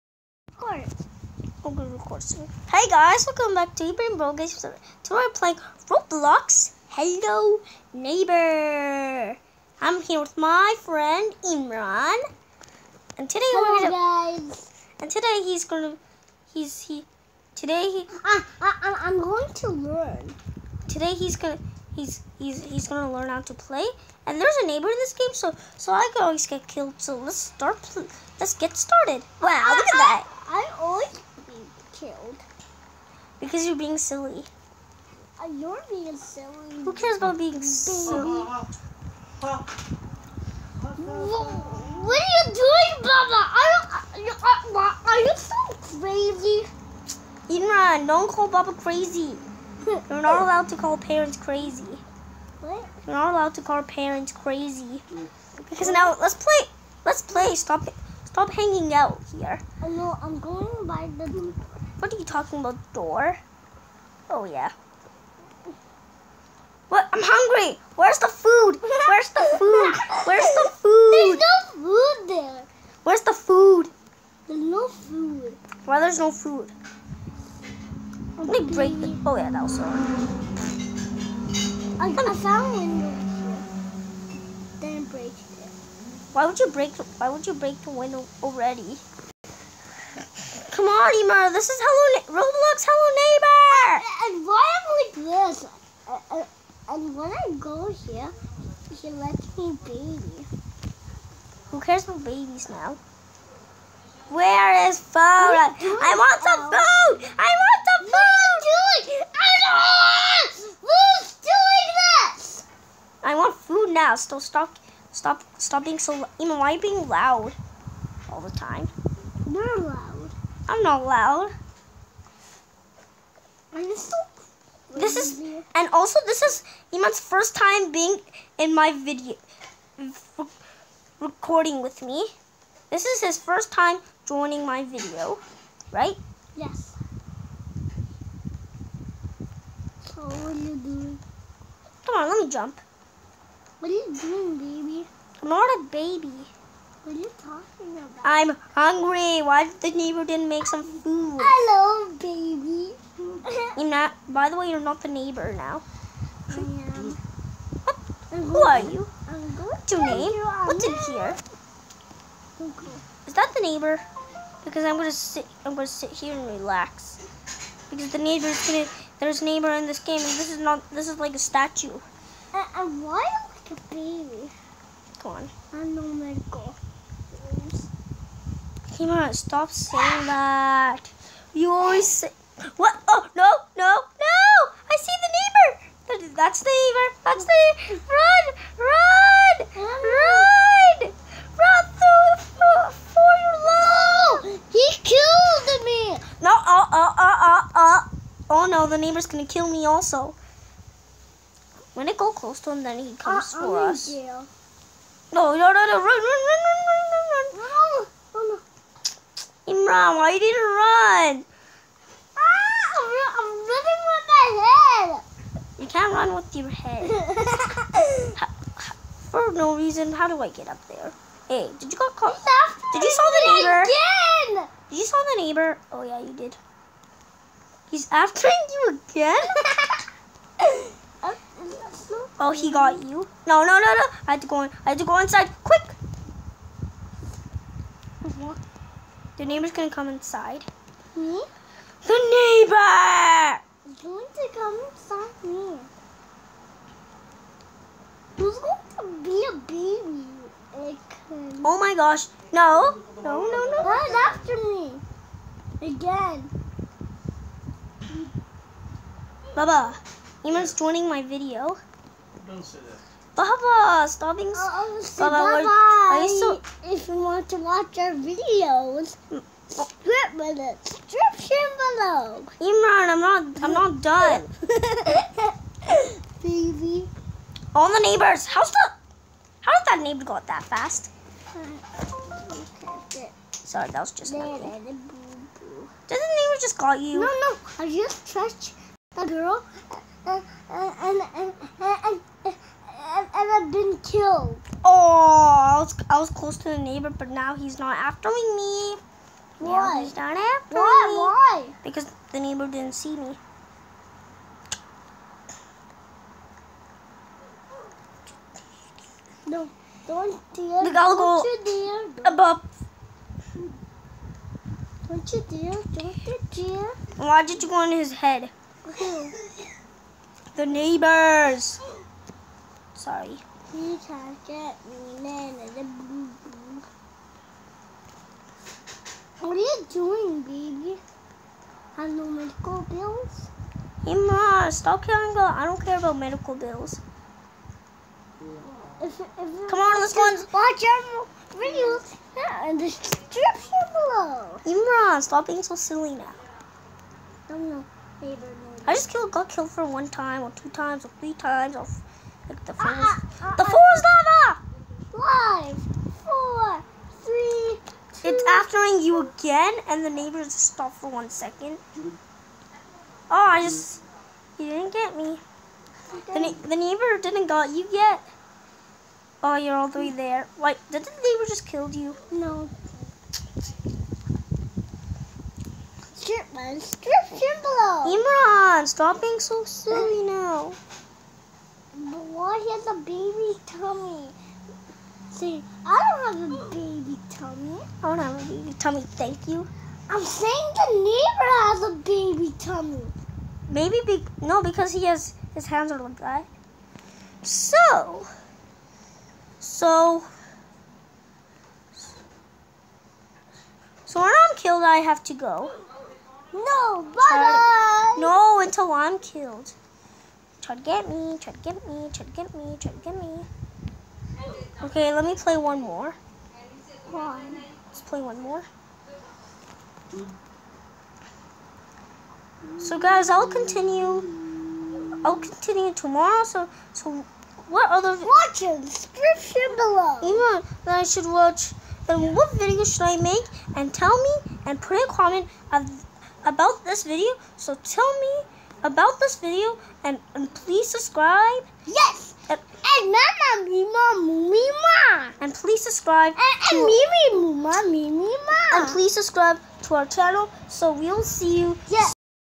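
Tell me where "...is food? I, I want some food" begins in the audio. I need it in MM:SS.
01:44.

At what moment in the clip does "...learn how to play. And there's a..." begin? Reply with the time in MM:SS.
00:23.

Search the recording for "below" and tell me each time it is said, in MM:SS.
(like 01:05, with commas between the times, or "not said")
04:31, 05:43, 06:17, 07:09.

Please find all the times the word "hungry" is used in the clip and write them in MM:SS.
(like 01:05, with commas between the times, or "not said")
01:07, 02:28.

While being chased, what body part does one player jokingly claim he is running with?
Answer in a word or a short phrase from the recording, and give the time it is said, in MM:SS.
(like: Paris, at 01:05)
His head, at 03:34.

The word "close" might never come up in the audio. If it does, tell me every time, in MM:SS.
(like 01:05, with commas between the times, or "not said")
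03:22, 04:56.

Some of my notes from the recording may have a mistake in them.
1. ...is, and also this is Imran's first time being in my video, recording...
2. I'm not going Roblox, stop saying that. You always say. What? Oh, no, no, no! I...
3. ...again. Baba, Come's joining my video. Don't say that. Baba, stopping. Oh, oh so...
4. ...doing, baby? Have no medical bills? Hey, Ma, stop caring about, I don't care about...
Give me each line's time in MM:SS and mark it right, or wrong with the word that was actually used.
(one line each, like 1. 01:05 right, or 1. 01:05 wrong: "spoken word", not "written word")
1. 02:05 right
2. 02:55 wrong: "Pokemon", not "Roblox"
3. 04:15 wrong: "Imran", not "Come"
4. 05:29 right.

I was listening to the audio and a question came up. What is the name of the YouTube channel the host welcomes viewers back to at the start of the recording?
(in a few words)
Ibrahim Bro Games.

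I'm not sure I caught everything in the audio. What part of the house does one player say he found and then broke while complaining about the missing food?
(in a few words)
Windows.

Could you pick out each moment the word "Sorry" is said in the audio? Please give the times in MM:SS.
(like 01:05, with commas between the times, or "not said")
04:43, 05:23.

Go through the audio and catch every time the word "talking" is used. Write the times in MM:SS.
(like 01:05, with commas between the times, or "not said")
01:02, 02:27.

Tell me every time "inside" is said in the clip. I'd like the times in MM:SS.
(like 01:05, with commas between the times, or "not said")
03:55, 04:00, 04:04.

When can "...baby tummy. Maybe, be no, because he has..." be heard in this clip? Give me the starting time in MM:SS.
06:31.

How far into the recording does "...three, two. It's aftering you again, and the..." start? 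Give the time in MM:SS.
05:57.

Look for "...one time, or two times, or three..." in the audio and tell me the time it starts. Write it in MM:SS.
05:49.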